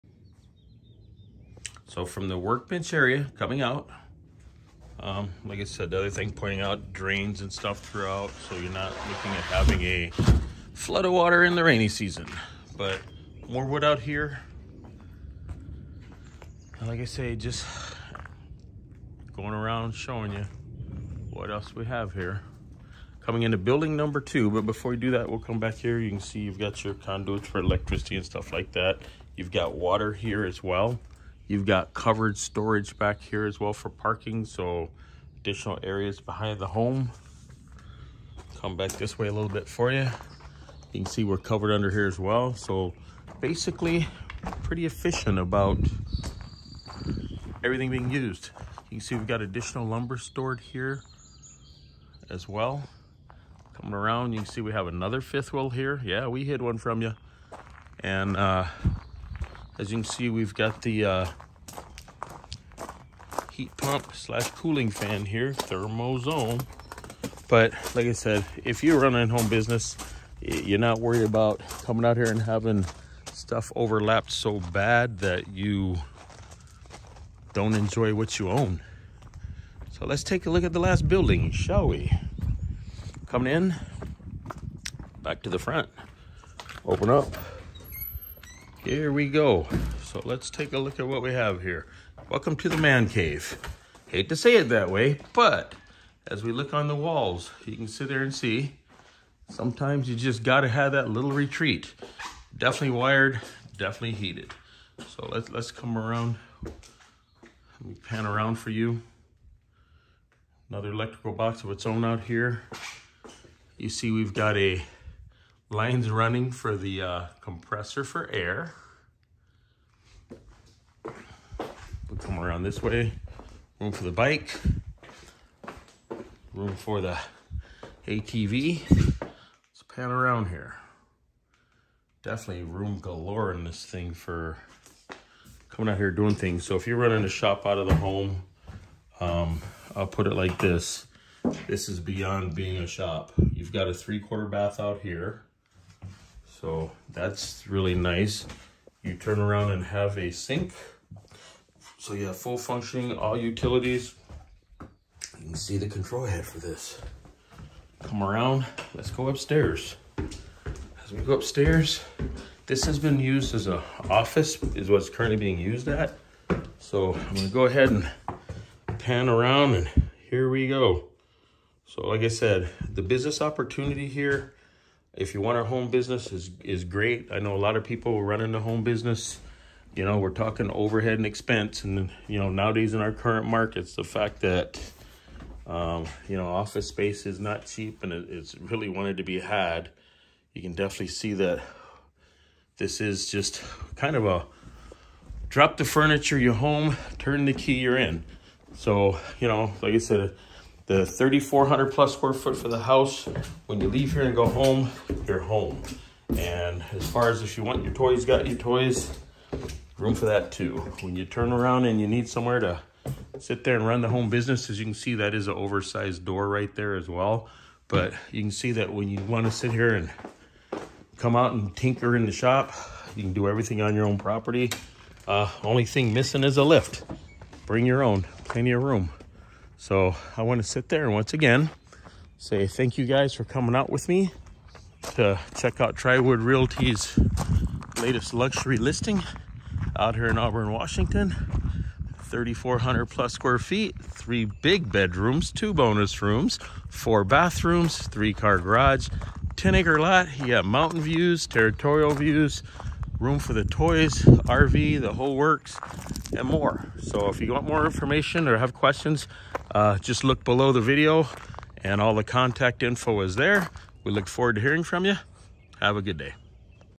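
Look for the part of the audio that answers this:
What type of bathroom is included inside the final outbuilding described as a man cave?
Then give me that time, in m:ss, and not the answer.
2:23.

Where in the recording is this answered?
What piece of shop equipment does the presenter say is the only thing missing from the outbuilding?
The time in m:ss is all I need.
3:46.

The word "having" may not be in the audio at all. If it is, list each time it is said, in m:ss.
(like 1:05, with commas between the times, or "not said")
0:09, 1:12.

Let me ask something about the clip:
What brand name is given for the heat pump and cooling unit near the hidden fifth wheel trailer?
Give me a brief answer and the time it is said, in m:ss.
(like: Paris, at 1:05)
Thermozone, at 1:05.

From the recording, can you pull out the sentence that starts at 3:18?
So you know, like I said the 3,400 plus square foot for the house.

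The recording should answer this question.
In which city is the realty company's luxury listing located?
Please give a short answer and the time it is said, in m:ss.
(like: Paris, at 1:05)
Auburn, Washington, at 4:00.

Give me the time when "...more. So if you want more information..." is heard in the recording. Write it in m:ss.
4:16.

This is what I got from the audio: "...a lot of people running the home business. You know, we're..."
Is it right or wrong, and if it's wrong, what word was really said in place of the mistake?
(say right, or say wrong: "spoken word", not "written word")
right.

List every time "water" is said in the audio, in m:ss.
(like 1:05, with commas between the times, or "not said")
0:11, 0:29.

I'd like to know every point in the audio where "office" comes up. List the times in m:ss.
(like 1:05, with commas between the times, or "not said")
2:44, 3:06.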